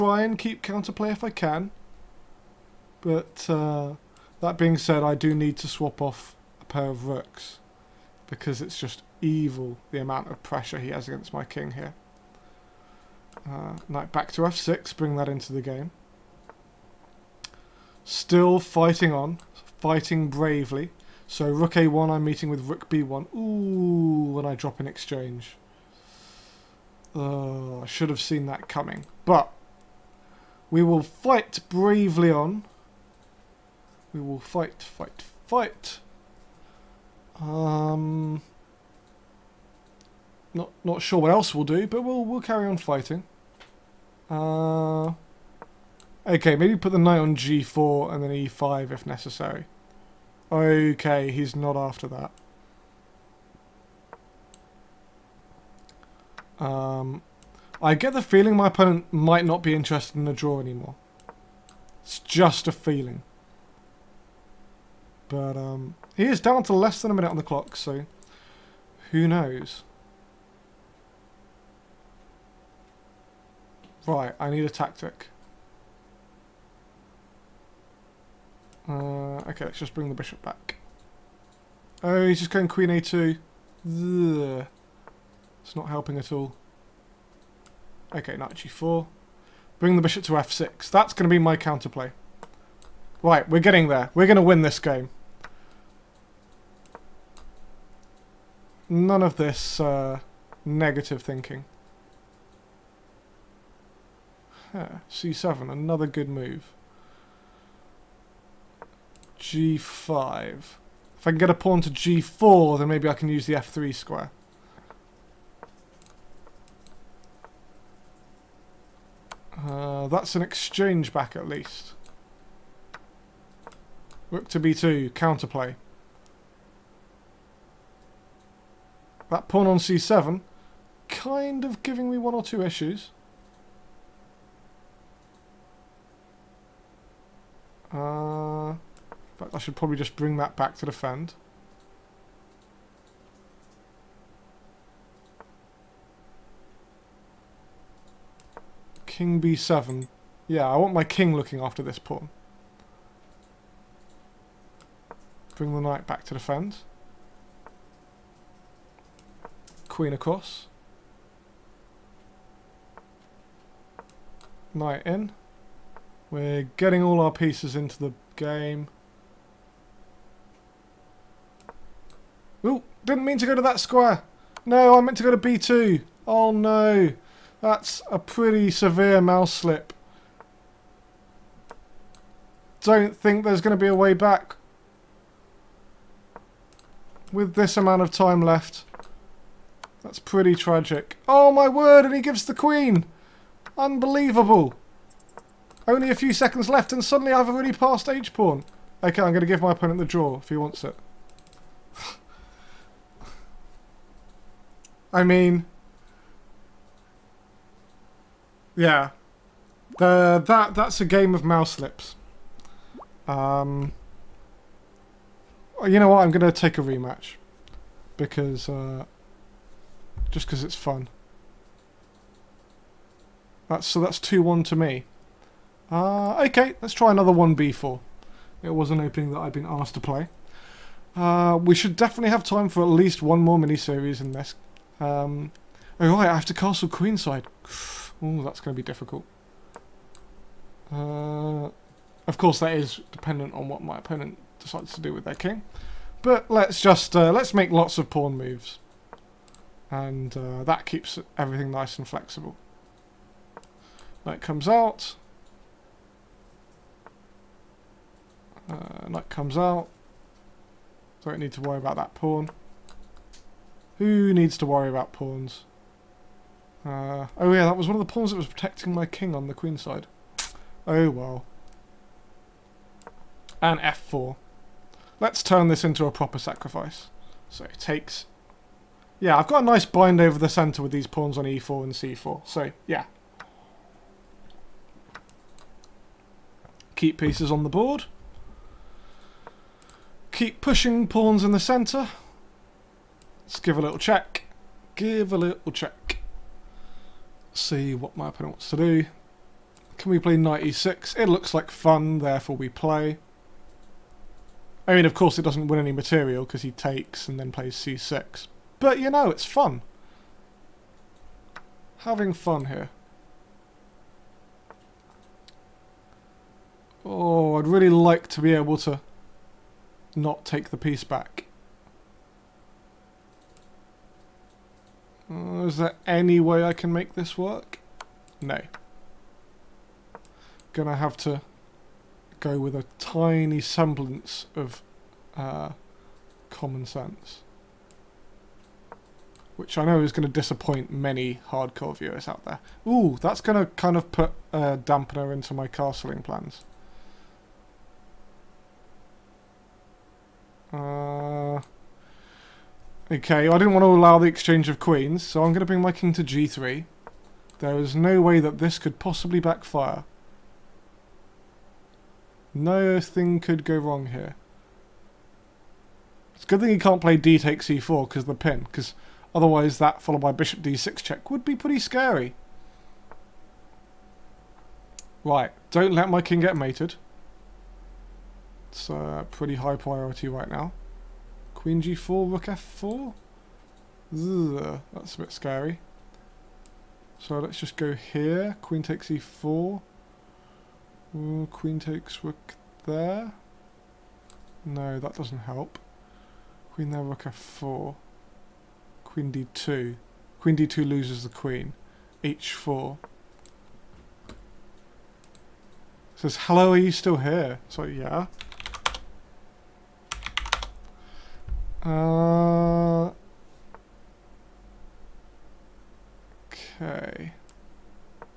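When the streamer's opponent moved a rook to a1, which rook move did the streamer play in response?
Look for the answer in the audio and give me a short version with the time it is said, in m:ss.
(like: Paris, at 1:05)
Rook b1, at 0:22.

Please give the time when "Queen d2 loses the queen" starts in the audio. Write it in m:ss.
6:40.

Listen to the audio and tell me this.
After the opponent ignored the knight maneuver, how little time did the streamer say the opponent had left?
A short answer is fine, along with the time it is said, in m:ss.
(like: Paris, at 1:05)
a minute, at 1:06.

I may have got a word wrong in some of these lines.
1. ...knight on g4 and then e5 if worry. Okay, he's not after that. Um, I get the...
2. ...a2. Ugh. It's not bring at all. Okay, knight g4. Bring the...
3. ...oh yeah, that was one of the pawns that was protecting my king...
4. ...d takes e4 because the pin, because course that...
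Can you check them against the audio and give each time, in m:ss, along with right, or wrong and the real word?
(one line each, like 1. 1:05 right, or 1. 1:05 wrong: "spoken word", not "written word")
1. 0:46 wrong: "necessary", not "worry"
2. 1:22 wrong: "helping", not "bring"
3. 4:27 right
4. 6:07 wrong: "otherwise", not "course".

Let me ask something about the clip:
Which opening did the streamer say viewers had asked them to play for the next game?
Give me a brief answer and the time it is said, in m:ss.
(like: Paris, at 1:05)
1B4, at 3:47.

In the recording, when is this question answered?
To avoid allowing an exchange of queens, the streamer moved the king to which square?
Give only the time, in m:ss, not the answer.
5:56.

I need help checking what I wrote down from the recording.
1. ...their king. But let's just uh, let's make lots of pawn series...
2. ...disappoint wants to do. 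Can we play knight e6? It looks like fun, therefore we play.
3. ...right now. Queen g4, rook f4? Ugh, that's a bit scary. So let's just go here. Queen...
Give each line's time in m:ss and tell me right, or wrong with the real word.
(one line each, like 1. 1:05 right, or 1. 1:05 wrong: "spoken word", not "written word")
1. 4:05 wrong: "moves", not "series"
2. 4:58 wrong: "opponent", not "disappoint"
3. 6:20 right.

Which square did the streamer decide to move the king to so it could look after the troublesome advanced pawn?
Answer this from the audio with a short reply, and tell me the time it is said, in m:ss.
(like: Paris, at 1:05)
b7, at 2:29.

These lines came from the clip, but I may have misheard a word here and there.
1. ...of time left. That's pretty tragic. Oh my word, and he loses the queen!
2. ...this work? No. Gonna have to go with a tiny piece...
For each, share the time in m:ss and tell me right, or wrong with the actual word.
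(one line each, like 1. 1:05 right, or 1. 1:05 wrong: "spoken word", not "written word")
1. 3:08 wrong: "gives", not "loses"
2. 5:27 wrong: "semblance", not "piece".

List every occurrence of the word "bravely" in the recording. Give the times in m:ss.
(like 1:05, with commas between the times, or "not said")
0:20, 0:31.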